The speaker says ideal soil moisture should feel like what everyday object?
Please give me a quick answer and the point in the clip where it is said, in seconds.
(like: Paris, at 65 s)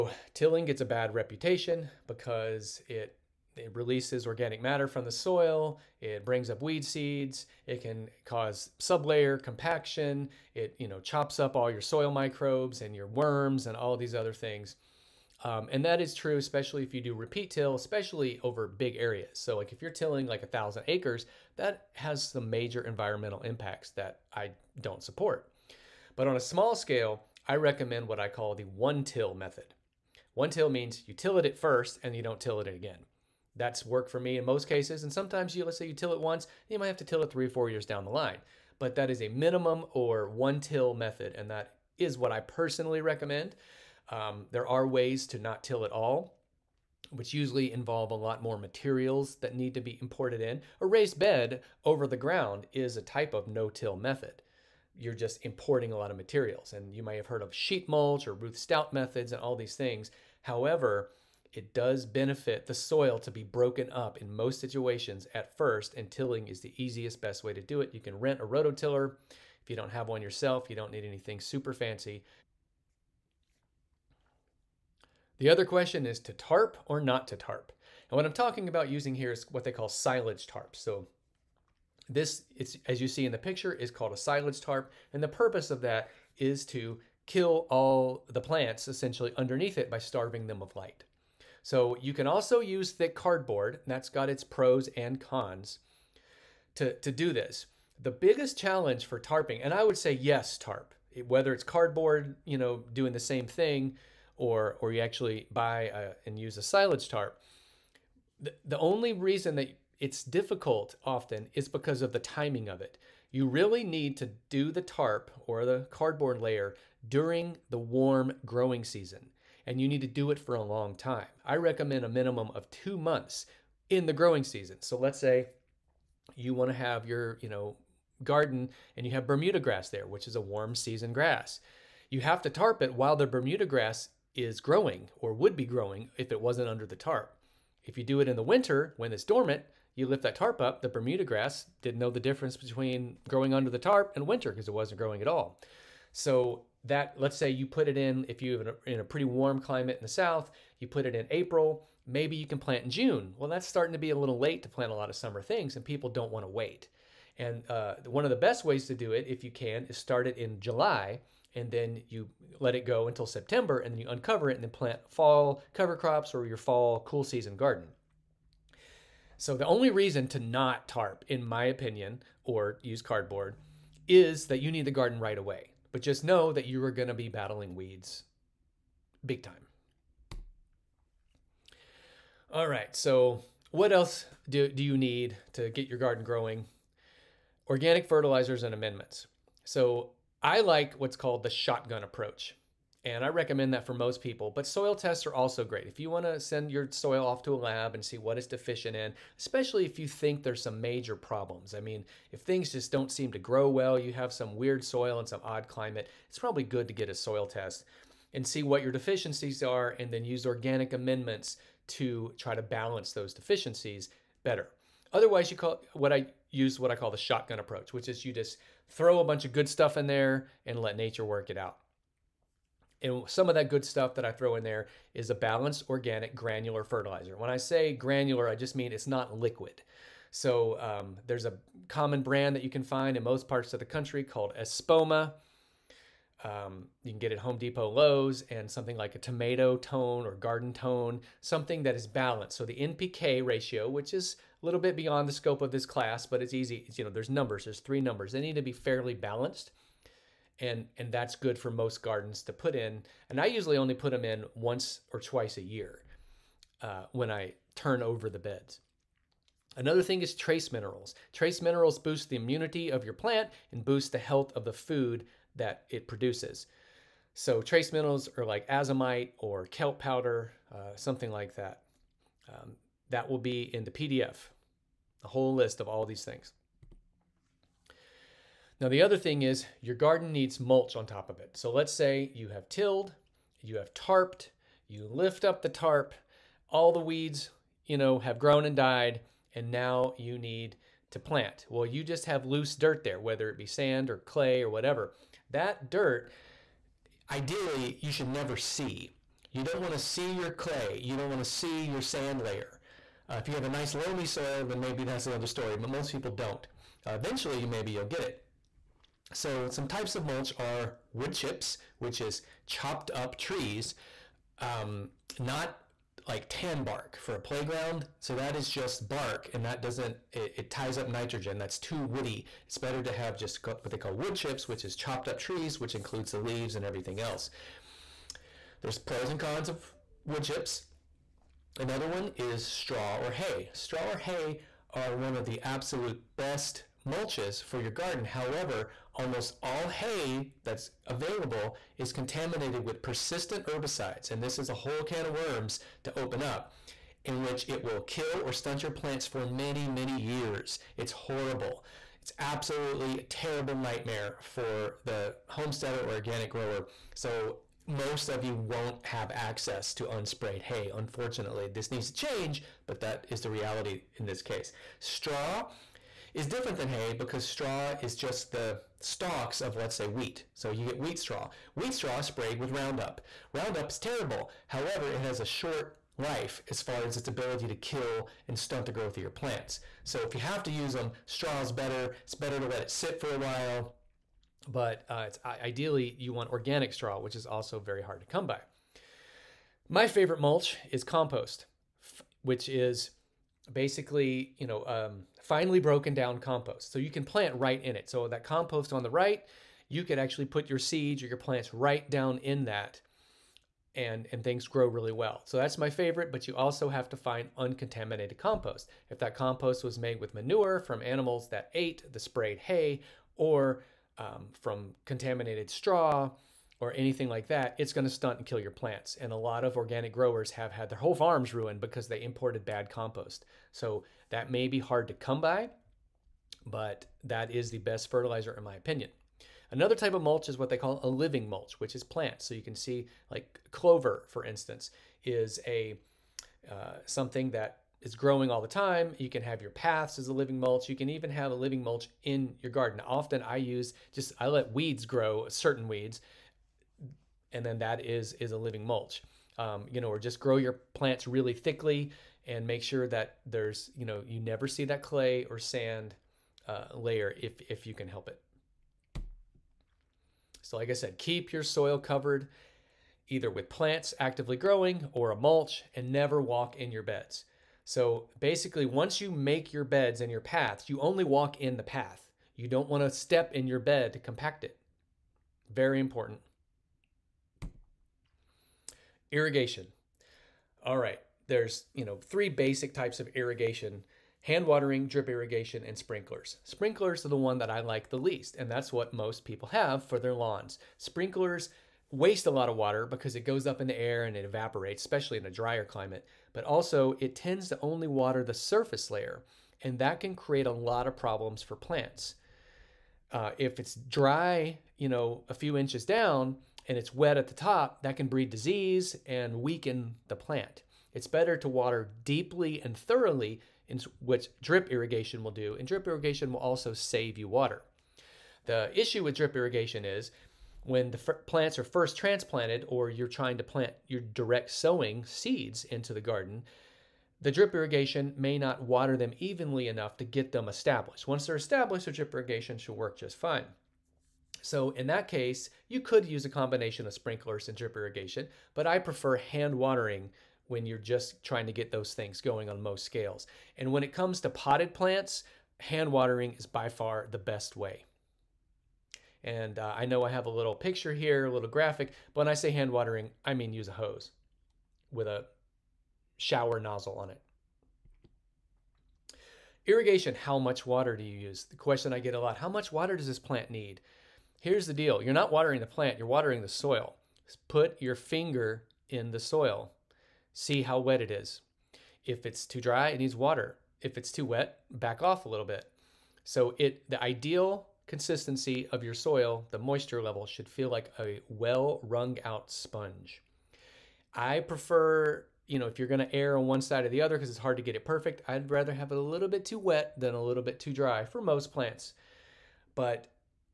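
a well wrung out sponge, at 581 s.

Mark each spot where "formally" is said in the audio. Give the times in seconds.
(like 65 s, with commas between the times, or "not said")
not said.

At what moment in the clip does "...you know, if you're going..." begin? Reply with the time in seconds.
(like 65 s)
585 s.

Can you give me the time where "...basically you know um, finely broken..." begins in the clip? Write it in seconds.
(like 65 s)
393 s.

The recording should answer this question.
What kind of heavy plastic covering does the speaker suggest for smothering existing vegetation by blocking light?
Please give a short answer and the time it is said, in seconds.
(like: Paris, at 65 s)
silage tarps, at 79 s.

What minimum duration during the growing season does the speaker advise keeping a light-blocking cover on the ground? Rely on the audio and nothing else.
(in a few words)
2 months.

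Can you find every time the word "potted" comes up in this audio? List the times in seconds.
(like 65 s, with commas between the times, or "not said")
544 s.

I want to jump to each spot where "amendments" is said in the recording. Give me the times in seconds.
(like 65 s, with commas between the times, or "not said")
188 s, 210 s.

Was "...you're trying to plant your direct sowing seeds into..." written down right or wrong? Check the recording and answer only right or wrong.
right.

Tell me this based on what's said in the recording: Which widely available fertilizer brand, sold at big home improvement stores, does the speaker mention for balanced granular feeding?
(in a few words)
Espoma.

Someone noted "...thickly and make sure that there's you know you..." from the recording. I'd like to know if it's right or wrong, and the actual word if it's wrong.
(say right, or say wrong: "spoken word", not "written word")
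right.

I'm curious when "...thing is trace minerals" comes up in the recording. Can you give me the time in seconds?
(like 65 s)
260 s.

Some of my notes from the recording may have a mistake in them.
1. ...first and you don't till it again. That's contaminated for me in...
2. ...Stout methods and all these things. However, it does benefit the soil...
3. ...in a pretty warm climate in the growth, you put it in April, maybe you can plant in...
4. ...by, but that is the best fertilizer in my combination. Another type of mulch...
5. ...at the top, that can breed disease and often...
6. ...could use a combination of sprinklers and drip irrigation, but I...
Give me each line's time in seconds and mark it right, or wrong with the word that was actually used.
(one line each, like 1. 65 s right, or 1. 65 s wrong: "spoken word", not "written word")
1. 31 s wrong: "worked", not "contaminated"
2. 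58 s right
3. 148 s wrong: "south", not "growth"
4. 425 s wrong: "opinion", not "combination"
5. 507 s wrong: "weaken", not "often"
6. 536 s right.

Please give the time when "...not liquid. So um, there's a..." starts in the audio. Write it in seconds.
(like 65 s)
229 s.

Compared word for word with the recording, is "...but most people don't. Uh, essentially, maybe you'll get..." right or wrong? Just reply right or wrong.
wrong.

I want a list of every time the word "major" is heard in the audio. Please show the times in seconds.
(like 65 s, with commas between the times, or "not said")
22 s, 200 s.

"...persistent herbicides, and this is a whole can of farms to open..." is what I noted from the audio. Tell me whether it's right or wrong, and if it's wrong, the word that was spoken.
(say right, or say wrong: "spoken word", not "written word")
wrong: "worms", not "farms".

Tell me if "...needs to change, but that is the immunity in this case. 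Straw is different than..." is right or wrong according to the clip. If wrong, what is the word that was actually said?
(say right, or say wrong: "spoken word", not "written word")
wrong: "reality", not "immunity".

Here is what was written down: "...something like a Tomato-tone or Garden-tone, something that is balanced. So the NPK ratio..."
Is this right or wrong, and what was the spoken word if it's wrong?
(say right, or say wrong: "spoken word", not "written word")
right.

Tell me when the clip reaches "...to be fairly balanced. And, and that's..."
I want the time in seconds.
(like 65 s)
248 s.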